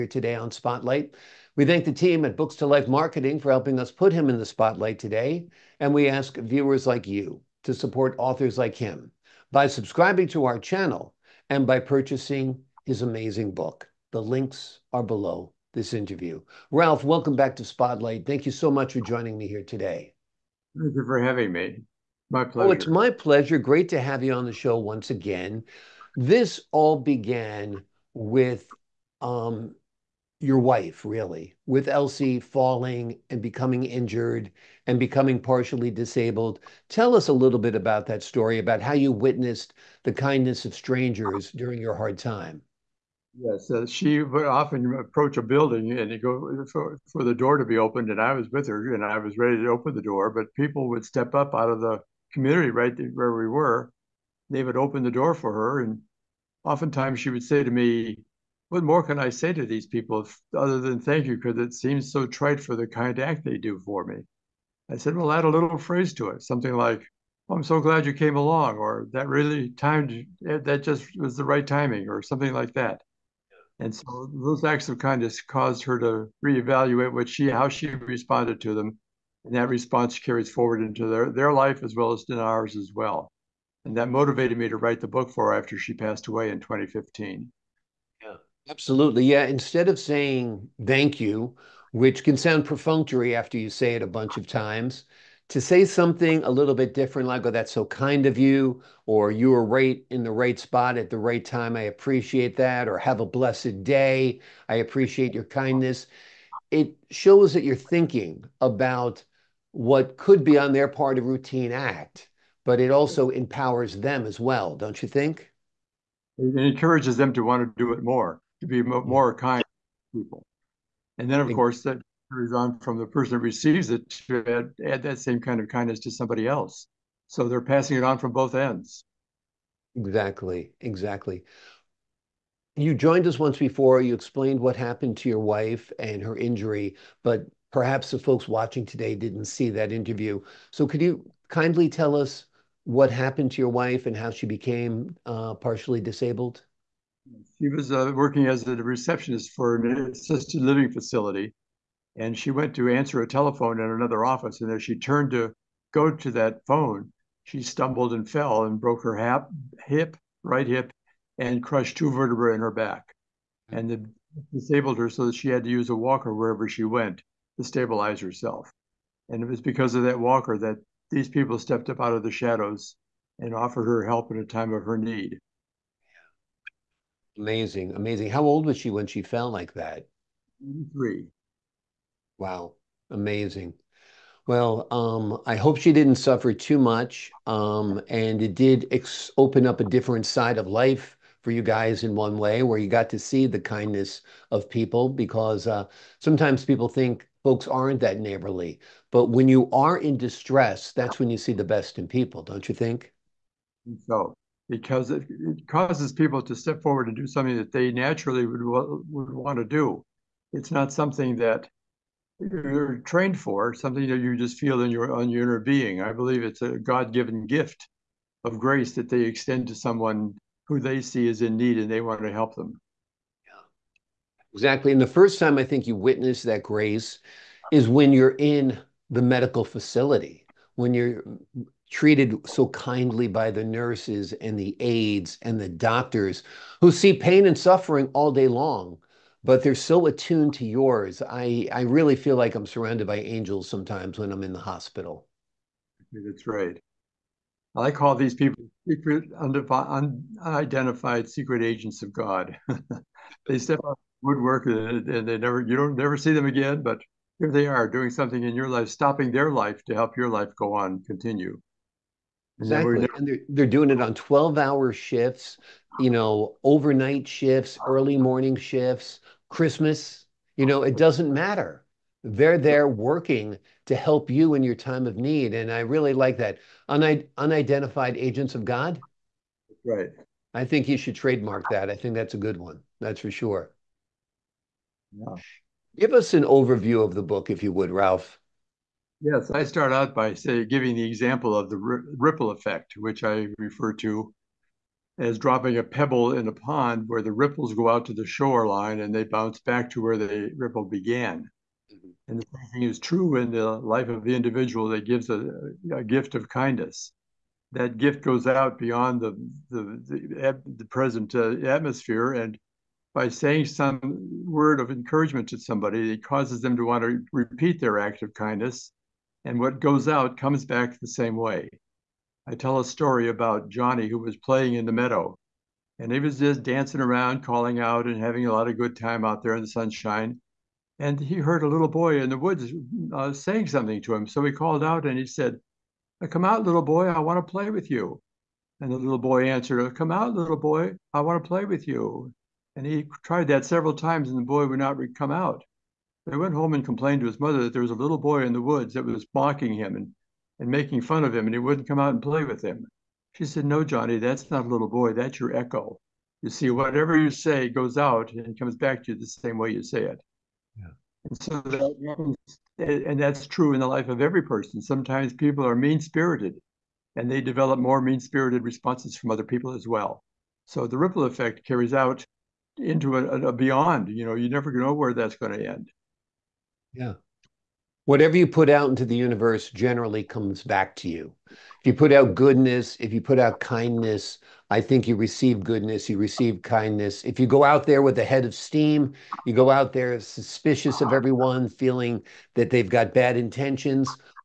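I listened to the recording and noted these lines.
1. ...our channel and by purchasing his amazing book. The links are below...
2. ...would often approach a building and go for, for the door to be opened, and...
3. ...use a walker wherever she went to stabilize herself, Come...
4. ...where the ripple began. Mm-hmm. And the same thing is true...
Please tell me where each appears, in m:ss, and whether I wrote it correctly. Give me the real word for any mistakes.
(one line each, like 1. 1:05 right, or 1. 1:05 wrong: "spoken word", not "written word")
1. 0:10 right
2. 0:44 right
3. 2:45 wrong: "And", not "Come"
4. 5:00 right.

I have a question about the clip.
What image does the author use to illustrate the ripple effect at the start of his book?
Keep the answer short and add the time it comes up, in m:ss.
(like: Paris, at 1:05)
Dropping a pebble in a pond, at 4:55.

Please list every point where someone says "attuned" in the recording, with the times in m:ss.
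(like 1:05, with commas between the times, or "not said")
4:00.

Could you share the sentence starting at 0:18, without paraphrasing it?
Thank you so much for joining me here today.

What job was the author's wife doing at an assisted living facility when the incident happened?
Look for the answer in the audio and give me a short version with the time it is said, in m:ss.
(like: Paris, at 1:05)
Receptionist, at 2:28.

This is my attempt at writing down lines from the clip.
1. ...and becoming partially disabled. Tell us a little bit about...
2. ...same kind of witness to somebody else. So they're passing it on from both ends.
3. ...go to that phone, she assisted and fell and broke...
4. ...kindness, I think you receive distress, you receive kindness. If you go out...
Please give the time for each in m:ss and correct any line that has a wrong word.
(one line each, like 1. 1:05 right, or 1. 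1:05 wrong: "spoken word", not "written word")
1. 0:34 right
2. 2:05 wrong: "kindness", not "witness"
3. 2:35 wrong: "stumbled", not "assisted"
4. 6:23 wrong: "goodness", not "distress".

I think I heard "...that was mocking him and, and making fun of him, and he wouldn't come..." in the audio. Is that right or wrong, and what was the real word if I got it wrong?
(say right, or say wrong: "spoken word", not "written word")
right.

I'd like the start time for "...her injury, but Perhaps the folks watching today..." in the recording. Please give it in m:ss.
2:16.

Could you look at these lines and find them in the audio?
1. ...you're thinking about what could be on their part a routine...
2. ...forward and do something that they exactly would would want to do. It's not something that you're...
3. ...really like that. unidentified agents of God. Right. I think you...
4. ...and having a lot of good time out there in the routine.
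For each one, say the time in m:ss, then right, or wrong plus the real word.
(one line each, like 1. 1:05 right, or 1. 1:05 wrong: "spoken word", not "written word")
1. 1:47 right
2. 3:26 wrong: "naturally", not "exactly"
3. 4:35 right
4. 5:28 wrong: "sunshine", not "routine".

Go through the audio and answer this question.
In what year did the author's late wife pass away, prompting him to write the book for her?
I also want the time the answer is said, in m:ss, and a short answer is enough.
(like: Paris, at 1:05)
2015, at 1:26.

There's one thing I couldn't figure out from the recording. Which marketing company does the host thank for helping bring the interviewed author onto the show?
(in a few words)
Books to Life Marketing.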